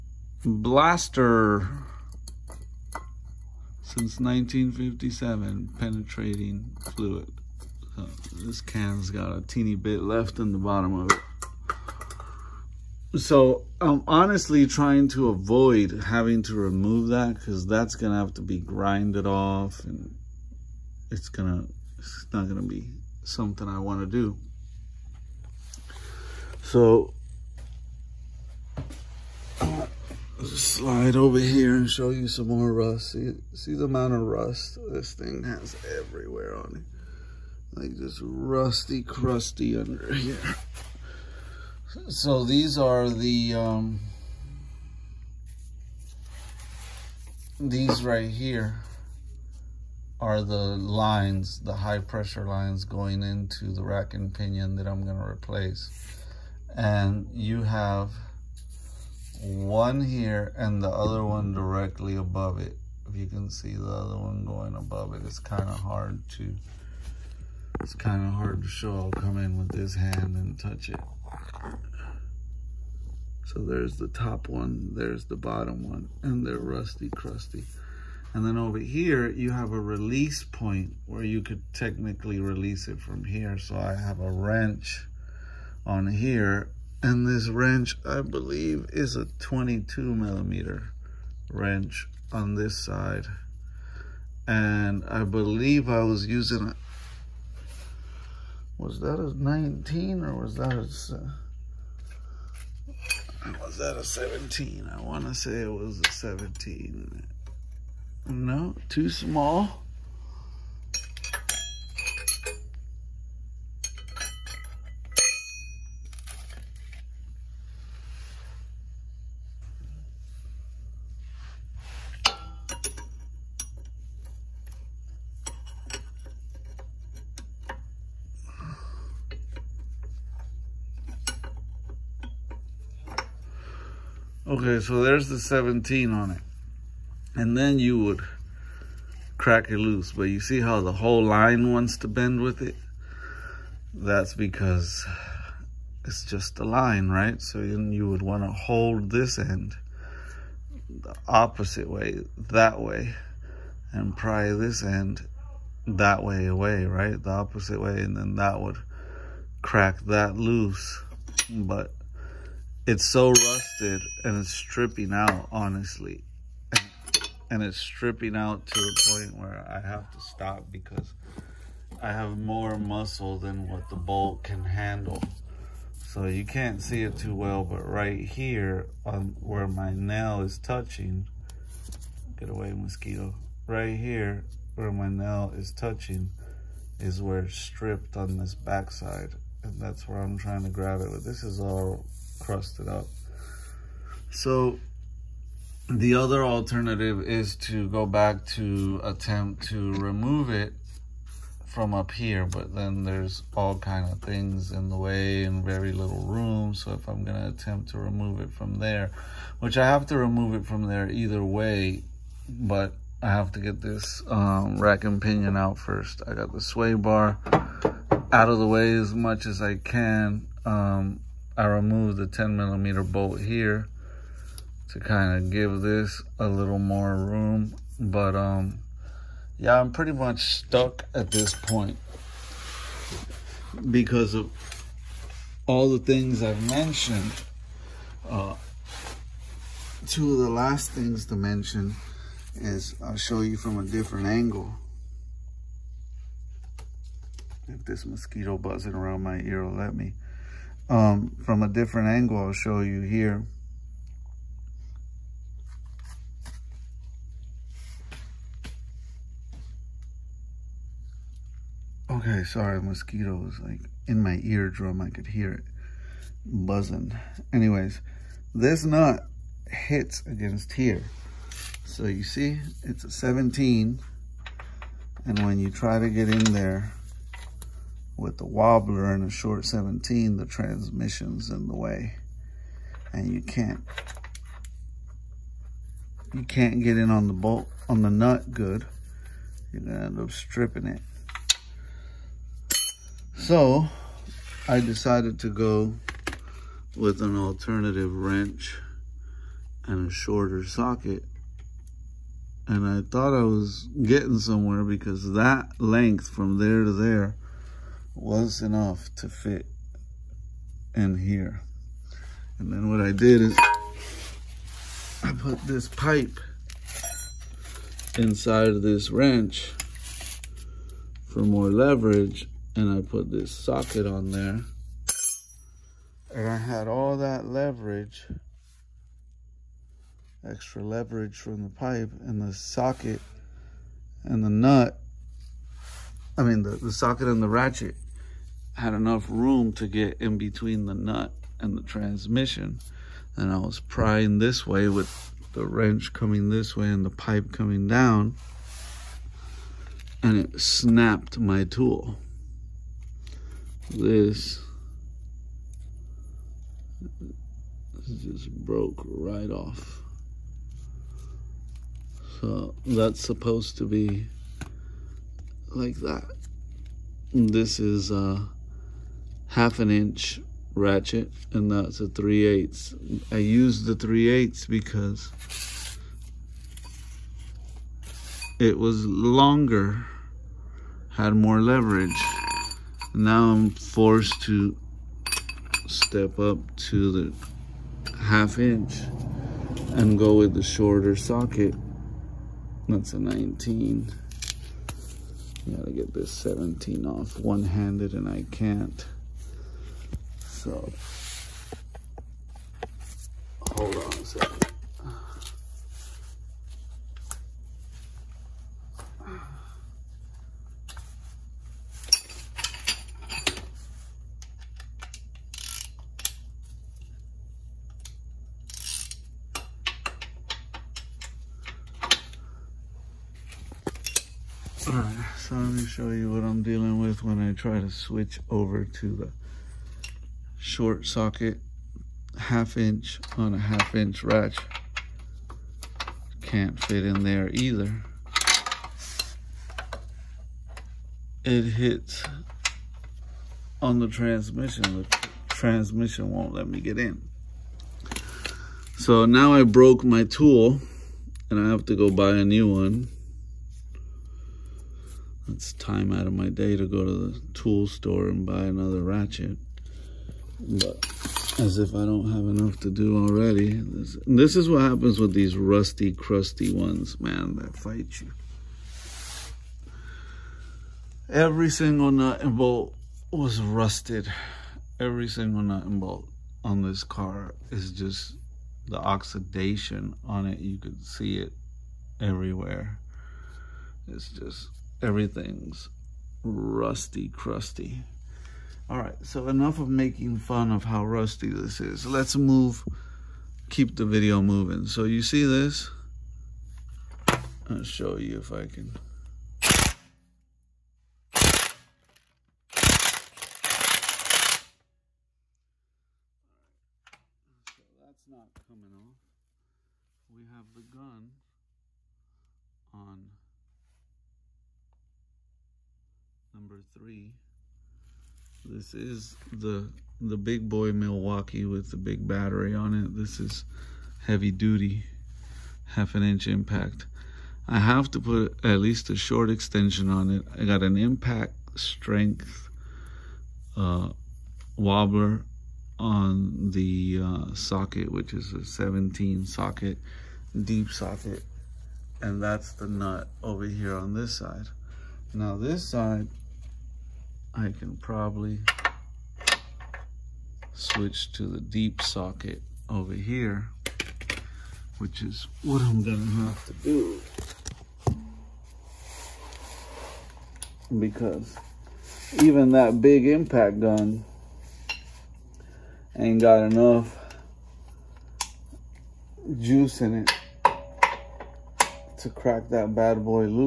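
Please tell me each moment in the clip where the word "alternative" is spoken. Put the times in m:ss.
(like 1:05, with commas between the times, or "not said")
3:16, 4:57.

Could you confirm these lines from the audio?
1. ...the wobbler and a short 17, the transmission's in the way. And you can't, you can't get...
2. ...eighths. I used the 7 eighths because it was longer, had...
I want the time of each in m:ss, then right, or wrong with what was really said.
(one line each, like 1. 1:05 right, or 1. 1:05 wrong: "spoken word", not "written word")
1. 4:38 right
2. 6:12 wrong: "3", not "7".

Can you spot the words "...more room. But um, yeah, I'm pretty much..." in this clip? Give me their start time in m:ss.
3:46.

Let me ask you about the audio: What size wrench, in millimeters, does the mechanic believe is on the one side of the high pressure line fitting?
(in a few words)
22 millimeter.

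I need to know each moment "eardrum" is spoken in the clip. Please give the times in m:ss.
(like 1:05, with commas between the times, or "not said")
4:24.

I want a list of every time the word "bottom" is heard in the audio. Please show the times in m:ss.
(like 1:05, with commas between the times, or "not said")
0:10, 1:15.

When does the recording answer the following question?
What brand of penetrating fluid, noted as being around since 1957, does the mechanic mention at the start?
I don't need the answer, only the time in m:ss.
0:00.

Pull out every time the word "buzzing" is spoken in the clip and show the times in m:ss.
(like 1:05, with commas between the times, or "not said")
4:08, 4:26.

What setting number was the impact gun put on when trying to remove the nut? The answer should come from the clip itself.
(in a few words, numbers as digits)
3.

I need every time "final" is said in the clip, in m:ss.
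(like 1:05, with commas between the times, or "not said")
not said.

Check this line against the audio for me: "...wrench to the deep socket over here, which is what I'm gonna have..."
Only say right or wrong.
wrong.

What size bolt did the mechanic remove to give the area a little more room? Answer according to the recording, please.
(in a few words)
10 millimeter.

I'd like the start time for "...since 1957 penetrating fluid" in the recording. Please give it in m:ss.
0:03.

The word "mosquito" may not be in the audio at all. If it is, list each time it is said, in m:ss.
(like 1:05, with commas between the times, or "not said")
3:02, 4:08, 4:22.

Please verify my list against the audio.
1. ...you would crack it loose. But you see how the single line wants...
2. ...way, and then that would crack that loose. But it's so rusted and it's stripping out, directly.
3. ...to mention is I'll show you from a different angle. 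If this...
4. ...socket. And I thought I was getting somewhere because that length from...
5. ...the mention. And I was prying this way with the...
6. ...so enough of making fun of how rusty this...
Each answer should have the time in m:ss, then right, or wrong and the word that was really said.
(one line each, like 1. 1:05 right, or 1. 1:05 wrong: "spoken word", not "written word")
1. 2:17 wrong: "whole", not "single"
2. 2:37 wrong: "honestly", not "directly"
3. 4:01 right
4. 5:00 right
5. 5:41 wrong: "transmission", not "mention"
6. 8:09 right.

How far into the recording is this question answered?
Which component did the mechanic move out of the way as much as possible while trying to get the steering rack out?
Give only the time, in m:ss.
3:36.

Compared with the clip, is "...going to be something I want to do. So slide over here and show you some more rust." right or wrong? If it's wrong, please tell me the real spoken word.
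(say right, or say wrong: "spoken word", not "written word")
right.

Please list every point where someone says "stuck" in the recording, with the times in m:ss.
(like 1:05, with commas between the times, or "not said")
3:50.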